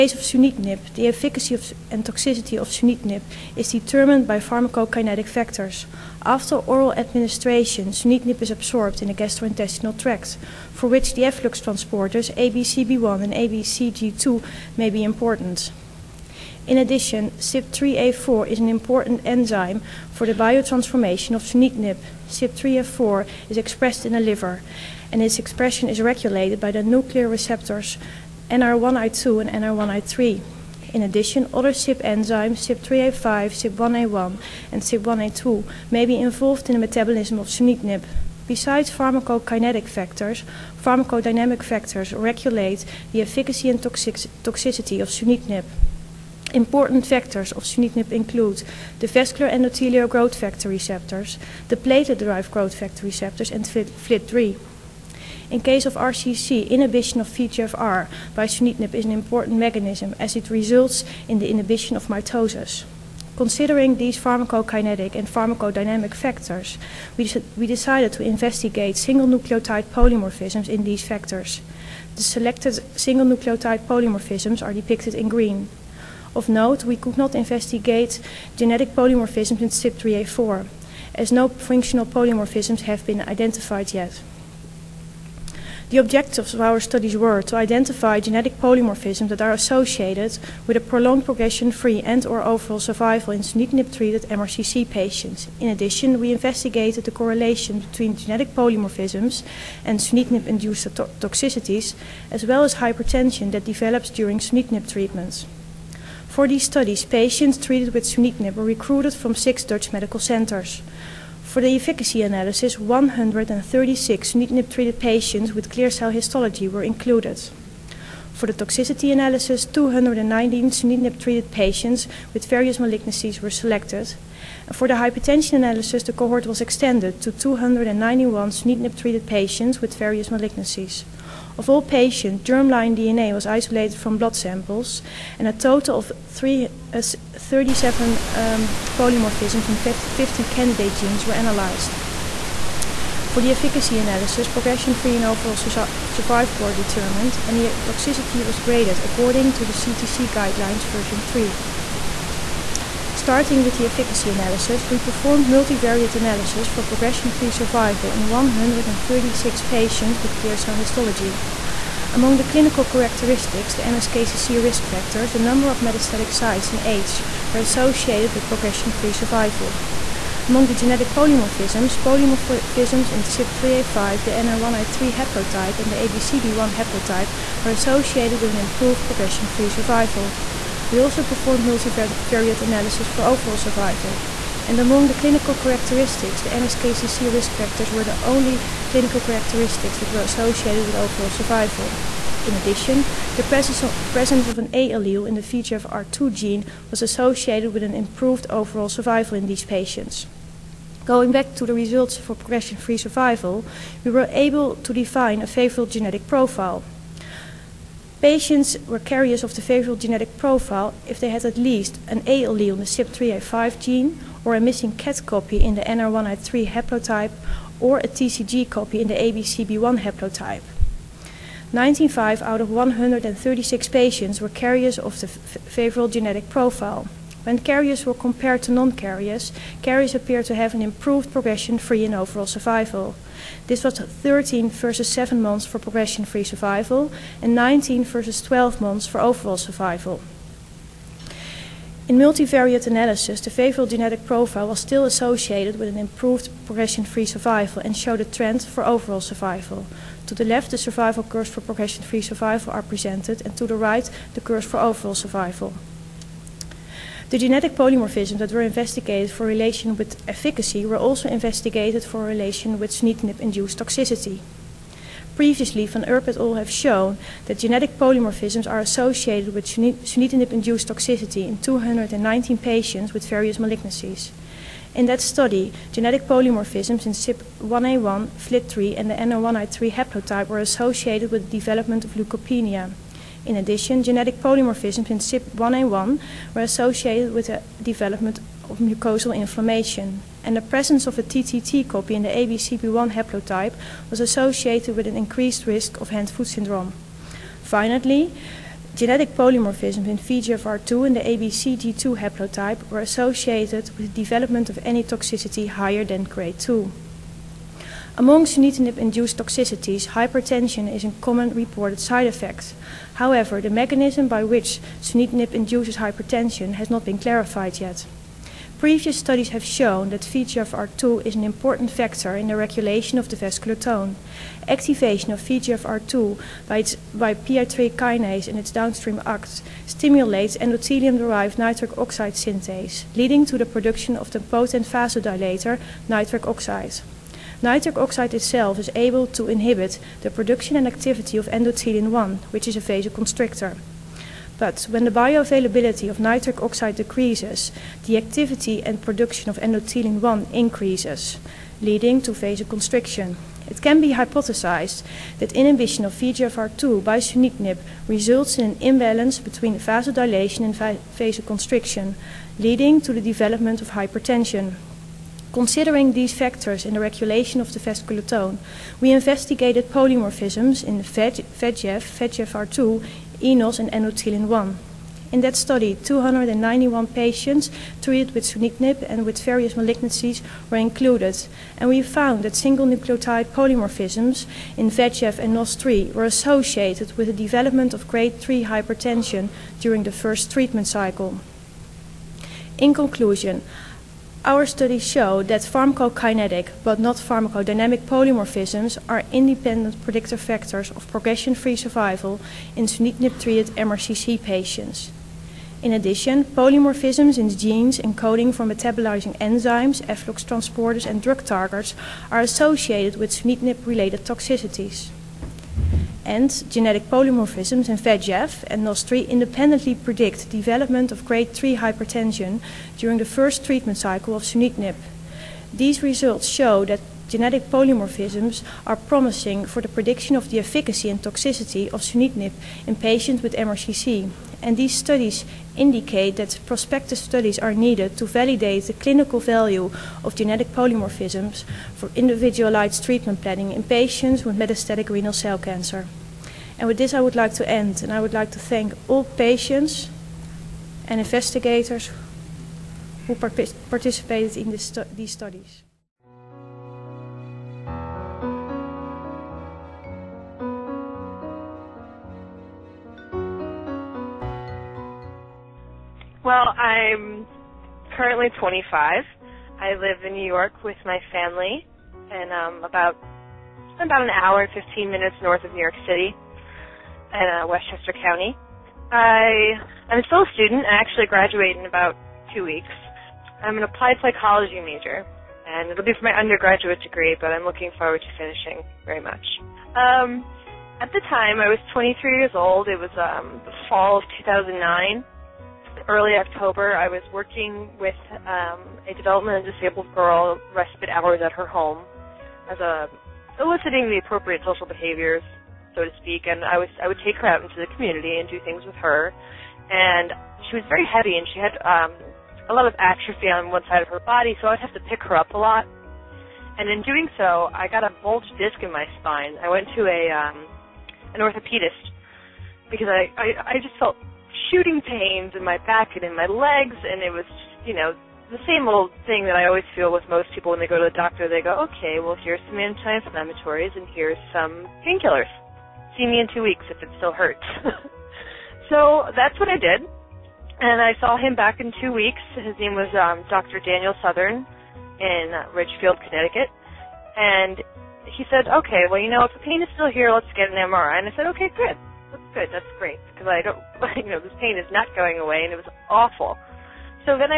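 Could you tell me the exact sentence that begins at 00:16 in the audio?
In addition, CYP3A4 is an important enzyme for the biotransformation of sunitinib.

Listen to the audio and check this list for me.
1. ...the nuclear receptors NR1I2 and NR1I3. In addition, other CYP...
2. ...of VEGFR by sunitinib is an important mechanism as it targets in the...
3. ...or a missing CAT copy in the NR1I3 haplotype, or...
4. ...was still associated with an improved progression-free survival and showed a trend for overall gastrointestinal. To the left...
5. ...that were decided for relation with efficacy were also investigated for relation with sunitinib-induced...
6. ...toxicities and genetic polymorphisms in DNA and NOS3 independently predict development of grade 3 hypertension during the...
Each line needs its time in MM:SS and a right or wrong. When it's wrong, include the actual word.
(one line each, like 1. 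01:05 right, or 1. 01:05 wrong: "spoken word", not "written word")
1. 00:26 right
2. 00:57 wrong: "results", not "targets"
3. 03:34 right
4. 04:04 wrong: "survival", not "gastrointestinal"
5. 04:18 wrong: "investigated", not "decided"
6. 06:54 wrong: "VEGF", not "DNA".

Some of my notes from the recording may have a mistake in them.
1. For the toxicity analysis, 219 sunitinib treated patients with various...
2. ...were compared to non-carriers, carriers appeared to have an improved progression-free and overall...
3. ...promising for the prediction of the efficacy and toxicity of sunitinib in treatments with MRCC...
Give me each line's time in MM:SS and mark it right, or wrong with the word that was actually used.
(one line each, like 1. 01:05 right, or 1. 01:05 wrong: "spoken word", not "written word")
1. 01:58 right
2. 03:48 right
3. 07:08 wrong: "patients", not "treatments".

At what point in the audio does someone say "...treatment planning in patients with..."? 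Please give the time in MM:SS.
07:23.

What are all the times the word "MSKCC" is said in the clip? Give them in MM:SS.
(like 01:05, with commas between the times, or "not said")
02:43, 03:06.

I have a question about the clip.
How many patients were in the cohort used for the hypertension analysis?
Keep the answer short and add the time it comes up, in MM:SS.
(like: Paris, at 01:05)
291, at 02:07.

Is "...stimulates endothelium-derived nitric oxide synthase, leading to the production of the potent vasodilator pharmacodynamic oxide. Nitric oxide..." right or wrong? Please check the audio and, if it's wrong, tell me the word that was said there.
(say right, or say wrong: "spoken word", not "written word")
wrong: "nitric", not "pharmacodynamic".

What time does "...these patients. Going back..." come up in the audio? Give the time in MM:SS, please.
03:19.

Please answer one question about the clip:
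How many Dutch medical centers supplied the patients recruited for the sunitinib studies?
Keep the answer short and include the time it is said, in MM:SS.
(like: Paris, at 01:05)
6, at 01:49.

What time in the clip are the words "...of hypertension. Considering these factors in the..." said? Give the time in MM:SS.
06:03.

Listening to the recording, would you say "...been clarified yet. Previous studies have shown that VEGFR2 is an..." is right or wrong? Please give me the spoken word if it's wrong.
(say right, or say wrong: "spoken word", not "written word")
right.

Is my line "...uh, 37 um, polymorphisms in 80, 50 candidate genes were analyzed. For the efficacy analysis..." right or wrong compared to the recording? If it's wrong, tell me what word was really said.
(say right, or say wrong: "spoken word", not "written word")
wrong: "50", not "80".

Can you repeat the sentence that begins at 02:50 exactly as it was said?
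Among the genetic polymorphisms, polymorphisms in CYP3A5, the NR1I3 haplotype, and the ABCB1 haplotype were associated with an improved progression-free survival.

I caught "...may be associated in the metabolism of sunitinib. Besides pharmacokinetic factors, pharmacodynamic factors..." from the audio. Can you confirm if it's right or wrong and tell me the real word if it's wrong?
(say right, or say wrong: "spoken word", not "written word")
wrong: "involved", not "associated".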